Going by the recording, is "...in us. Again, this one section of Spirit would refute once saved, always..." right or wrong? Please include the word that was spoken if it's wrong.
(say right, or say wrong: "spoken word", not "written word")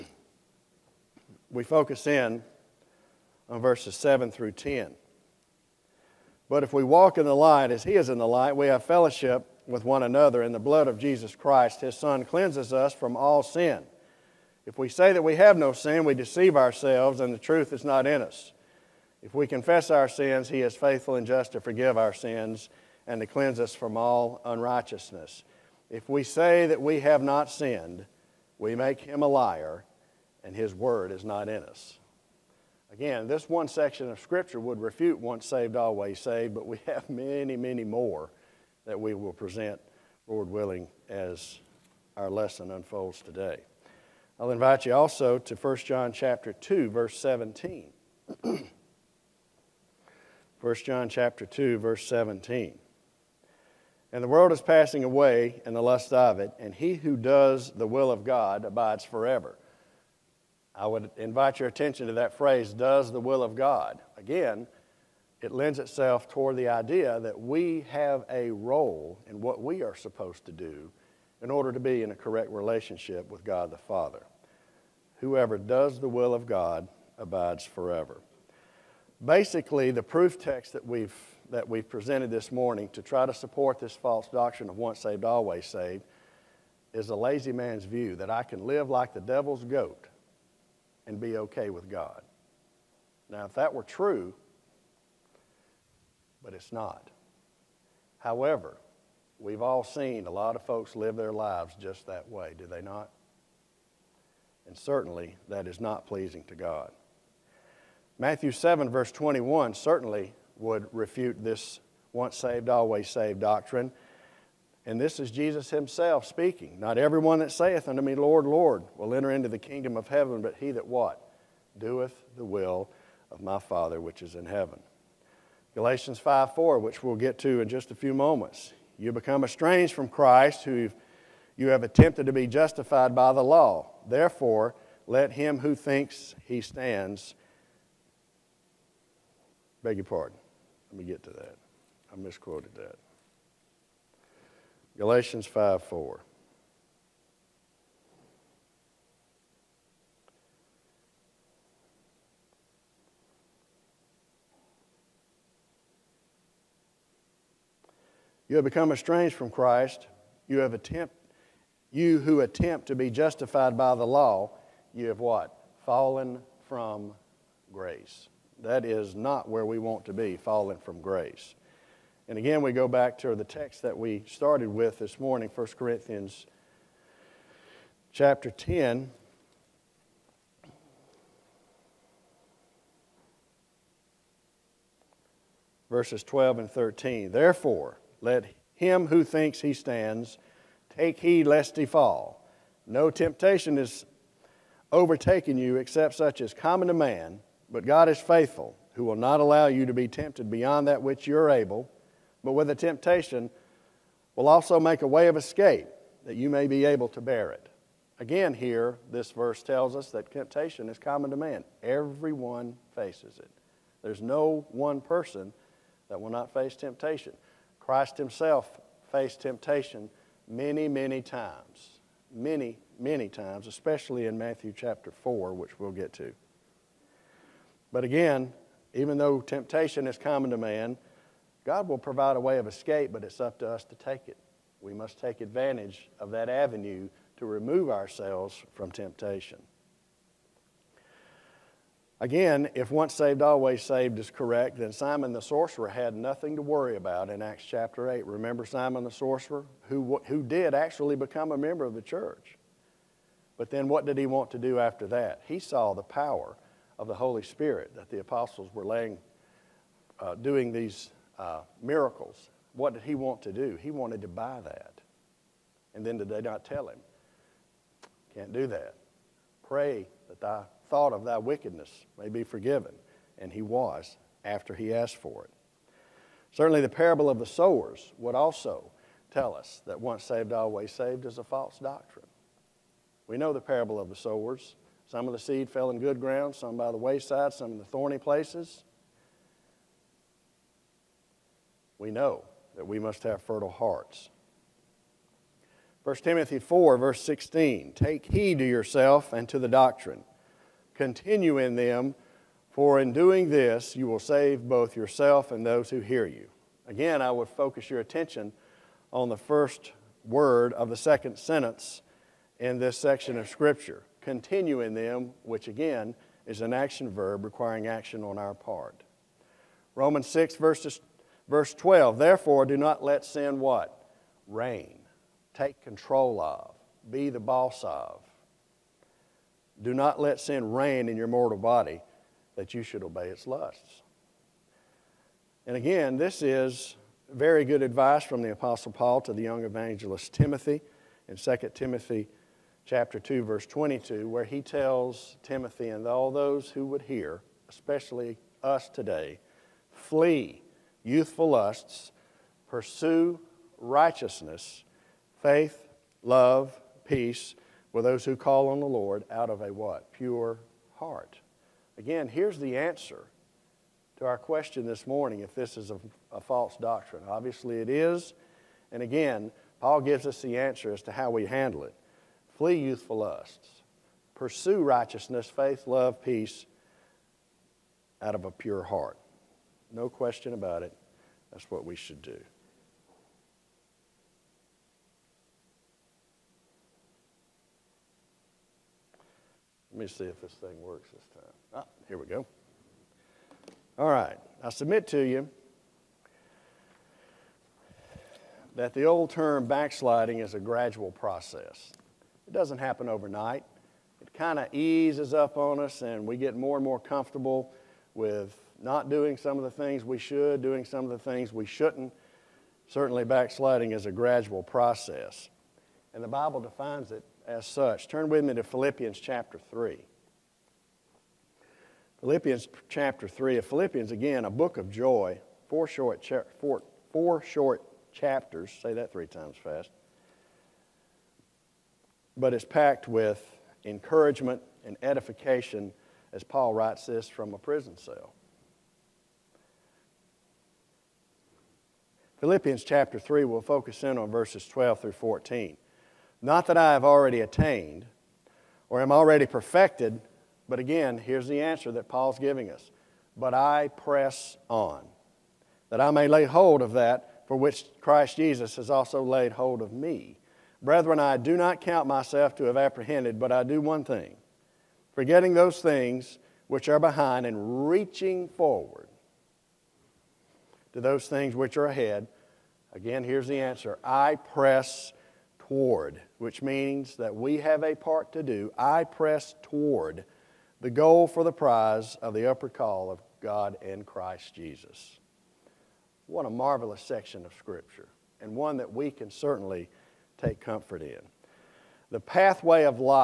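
wrong: "Scripture", not "Spirit".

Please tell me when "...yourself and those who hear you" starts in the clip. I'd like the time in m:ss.
5:04.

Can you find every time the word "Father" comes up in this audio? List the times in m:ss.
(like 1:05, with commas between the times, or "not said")
1:13, 2:03.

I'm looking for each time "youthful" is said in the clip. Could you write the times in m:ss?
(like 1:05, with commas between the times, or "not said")
5:51, 6:12.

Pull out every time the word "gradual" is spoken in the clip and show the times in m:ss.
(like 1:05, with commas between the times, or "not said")
6:40, 6:54.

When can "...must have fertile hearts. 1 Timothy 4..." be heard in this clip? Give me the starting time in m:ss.
4:52.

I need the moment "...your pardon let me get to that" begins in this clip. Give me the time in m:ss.
2:19.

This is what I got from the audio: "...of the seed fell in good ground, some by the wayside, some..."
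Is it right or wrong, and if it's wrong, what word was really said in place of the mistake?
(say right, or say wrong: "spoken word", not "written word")
right.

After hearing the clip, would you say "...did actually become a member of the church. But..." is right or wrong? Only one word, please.
right.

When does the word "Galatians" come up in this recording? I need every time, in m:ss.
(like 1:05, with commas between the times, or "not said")
2:05, 2:24.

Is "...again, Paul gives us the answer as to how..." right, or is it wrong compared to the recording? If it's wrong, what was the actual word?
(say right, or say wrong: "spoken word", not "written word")
right.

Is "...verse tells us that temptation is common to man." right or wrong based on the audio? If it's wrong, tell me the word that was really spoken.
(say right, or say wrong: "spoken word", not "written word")
right.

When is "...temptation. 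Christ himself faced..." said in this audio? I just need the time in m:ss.
3:36.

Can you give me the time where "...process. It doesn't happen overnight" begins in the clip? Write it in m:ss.
6:41.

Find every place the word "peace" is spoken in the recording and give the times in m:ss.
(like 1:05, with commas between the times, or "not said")
5:57, 6:16.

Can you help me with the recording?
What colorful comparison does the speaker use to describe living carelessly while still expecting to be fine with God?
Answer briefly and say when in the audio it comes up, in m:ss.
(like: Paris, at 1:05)
the devil's goat, at 1:29.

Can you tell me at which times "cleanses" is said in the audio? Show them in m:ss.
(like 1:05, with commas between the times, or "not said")
0:12, 0:23.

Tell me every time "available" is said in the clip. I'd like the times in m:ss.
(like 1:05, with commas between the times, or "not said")
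not said.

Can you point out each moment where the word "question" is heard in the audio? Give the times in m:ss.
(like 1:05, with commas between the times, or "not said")
6:04, 6:20.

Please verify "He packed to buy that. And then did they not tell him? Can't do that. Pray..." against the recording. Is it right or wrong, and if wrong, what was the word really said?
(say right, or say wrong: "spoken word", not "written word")
wrong: "wanted", not "packed".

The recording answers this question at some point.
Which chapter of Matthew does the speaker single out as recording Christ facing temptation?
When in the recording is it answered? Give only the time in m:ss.
3:44.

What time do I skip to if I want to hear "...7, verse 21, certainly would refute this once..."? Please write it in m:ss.
1:48.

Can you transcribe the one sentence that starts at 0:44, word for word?
I'll invite you also to 1 John chapter 2, verse 17.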